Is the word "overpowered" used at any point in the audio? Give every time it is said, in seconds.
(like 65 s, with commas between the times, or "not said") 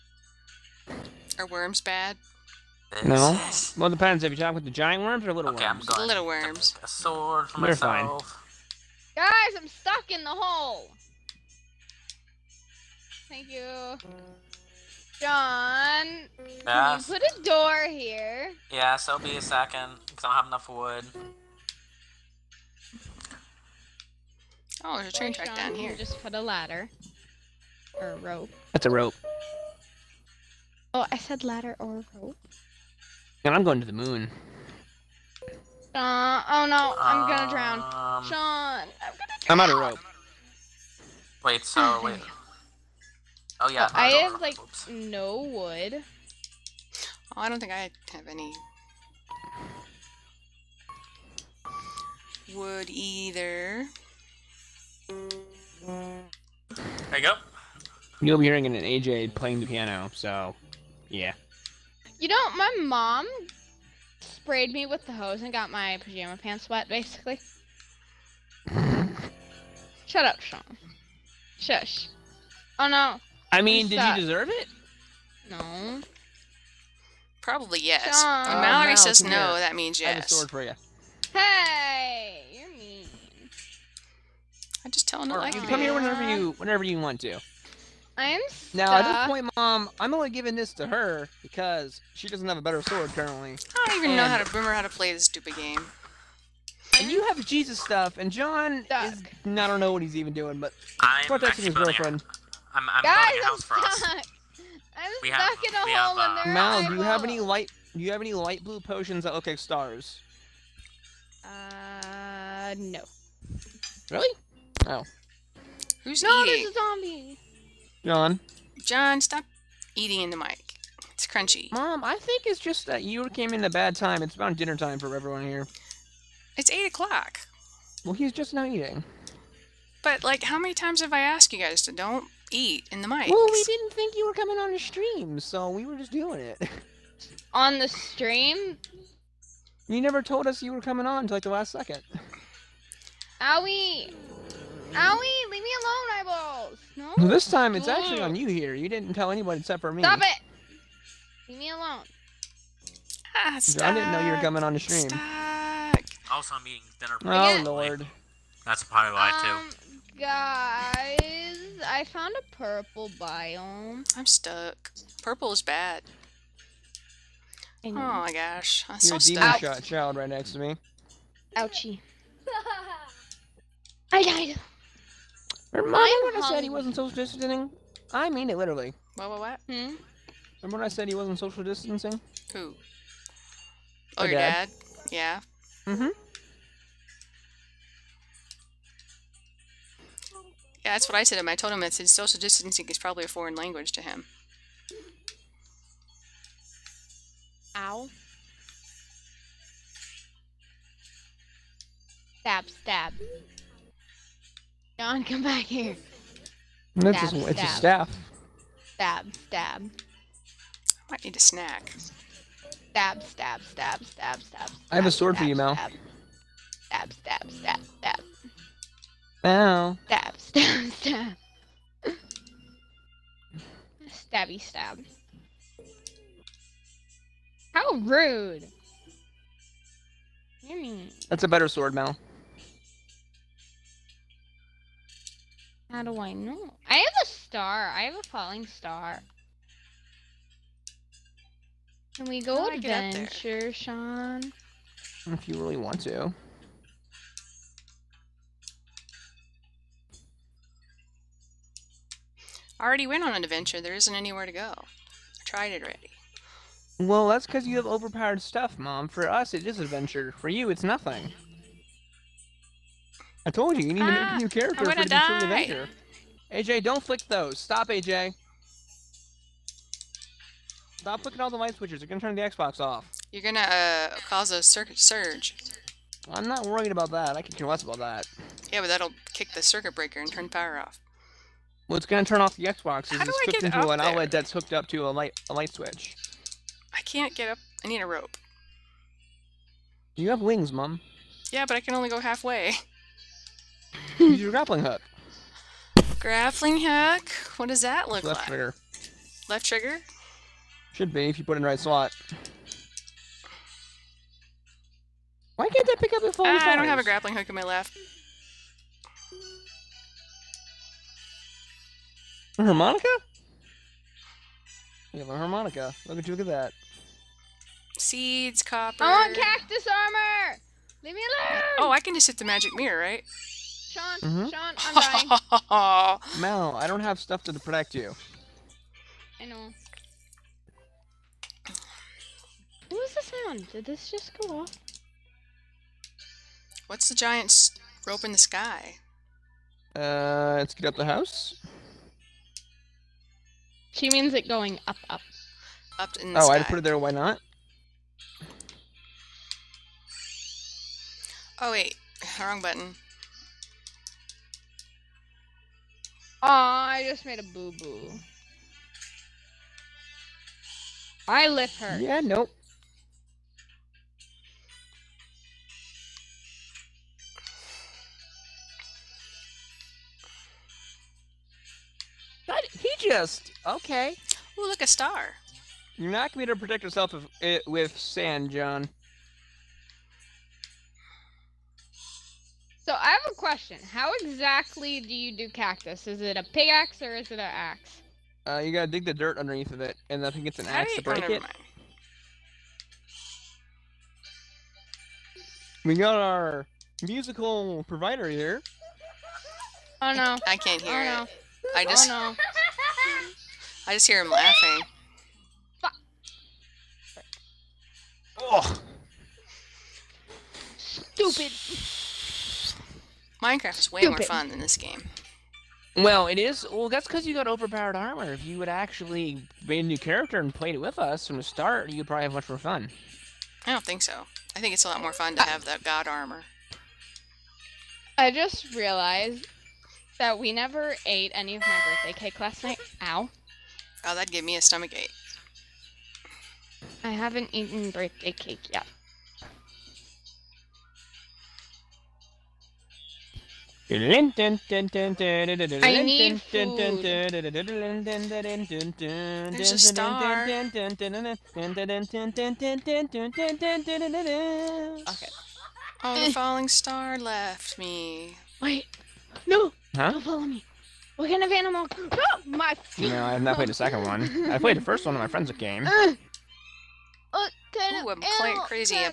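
257 s, 417 s.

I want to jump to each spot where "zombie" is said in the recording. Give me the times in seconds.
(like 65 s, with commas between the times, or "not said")
116 s.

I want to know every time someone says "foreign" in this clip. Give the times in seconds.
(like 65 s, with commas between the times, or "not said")
193 s.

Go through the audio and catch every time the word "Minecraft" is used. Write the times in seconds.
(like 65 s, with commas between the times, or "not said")
413 s.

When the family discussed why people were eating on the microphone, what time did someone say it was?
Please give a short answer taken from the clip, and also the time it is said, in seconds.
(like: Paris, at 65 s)
8 o'clock, at 126 s.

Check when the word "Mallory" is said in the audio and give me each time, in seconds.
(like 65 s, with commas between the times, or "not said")
78 s.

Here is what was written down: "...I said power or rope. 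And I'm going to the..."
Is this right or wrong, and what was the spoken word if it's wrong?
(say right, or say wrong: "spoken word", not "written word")
wrong: "ladder", not "power".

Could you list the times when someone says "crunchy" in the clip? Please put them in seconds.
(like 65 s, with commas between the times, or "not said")
121 s.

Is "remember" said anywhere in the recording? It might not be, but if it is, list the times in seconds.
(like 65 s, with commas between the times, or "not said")
94 s, 175 s, 180 s.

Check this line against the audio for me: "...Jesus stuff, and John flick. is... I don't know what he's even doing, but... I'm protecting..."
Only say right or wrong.
wrong.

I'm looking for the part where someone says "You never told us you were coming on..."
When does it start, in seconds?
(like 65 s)
139 s.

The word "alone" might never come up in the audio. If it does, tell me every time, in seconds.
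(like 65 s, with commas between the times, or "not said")
151 s, 321 s.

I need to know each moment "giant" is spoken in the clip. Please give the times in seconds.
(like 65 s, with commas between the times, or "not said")
4 s, 337 s.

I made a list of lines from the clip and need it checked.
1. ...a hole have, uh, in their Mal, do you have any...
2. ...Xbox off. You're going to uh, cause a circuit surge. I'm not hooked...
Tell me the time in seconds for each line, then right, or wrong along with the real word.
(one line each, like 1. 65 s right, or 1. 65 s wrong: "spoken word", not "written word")
1. 105 s right
2. 272 s wrong: "worried", not "hooked".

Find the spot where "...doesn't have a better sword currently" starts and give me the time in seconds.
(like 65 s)
92 s.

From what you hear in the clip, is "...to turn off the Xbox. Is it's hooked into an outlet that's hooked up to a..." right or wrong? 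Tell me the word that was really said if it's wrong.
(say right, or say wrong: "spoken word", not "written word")
right.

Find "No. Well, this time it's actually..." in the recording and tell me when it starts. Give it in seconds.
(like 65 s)
146 s.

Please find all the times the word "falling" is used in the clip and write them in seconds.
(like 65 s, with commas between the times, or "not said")
238 s, 456 s.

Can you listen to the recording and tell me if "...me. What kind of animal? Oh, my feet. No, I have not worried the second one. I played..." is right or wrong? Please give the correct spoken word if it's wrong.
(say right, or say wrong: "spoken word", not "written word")
wrong: "played", not "worried".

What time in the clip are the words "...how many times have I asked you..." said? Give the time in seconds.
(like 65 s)
130 s.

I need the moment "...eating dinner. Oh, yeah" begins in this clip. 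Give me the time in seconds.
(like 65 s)
156 s.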